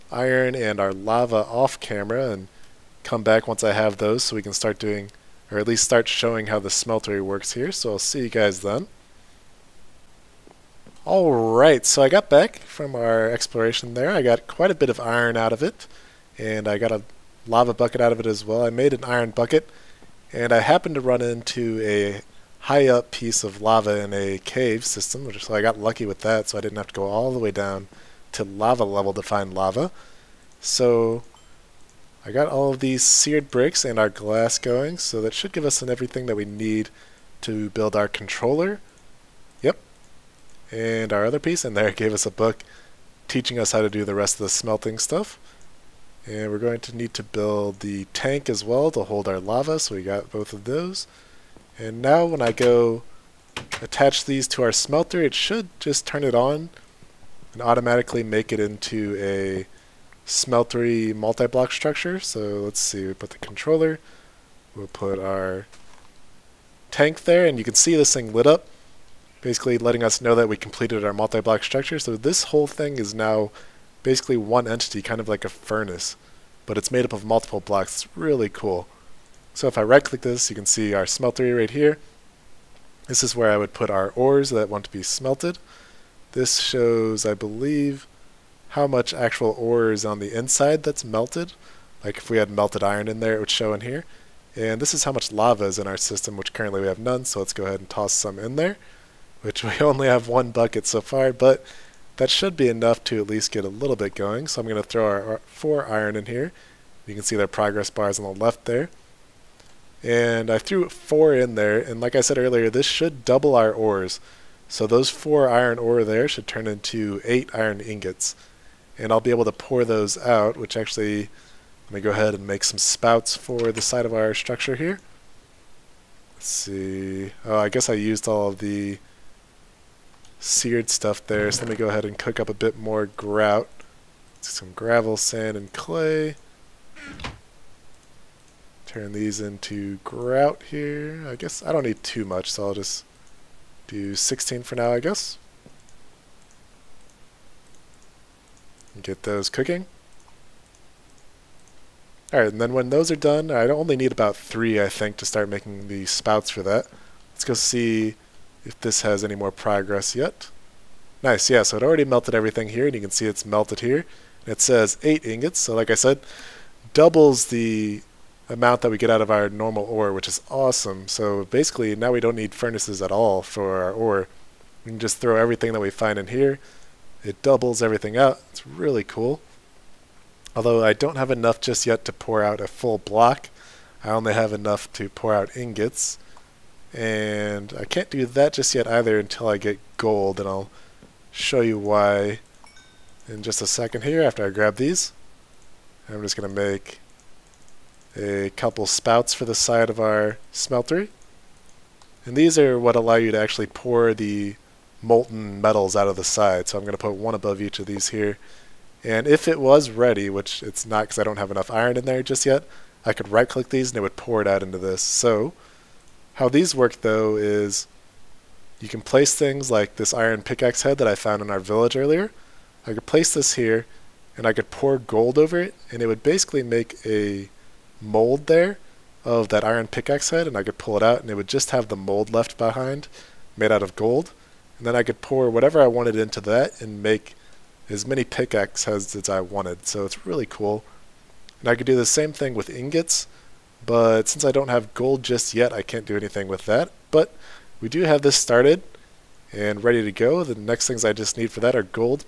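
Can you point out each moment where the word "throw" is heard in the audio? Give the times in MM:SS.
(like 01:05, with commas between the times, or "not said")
01:44, 02:55.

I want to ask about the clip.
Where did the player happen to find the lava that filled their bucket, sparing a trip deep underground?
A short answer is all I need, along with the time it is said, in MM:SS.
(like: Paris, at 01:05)
A cave system, at 00:23.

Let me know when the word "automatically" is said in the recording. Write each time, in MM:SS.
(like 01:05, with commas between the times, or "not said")
00:57.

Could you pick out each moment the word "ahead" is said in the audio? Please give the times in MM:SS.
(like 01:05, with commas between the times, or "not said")
01:37, 02:02, 02:11.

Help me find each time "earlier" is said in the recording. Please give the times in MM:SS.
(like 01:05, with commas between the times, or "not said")
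01:52, 03:41.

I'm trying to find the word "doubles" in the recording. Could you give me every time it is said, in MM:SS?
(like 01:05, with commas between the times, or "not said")
01:53, 02:46, 02:57.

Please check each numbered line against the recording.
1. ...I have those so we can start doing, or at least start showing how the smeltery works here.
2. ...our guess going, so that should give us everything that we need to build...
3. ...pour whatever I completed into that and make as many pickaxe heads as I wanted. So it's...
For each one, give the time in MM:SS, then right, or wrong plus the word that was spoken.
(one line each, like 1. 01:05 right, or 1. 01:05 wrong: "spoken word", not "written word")
1. 00:03 right
2. 00:33 wrong: "glass", not "guess"
3. 03:55 wrong: "wanted", not "completed".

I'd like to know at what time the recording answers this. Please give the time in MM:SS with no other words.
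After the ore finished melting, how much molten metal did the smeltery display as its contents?
02:45.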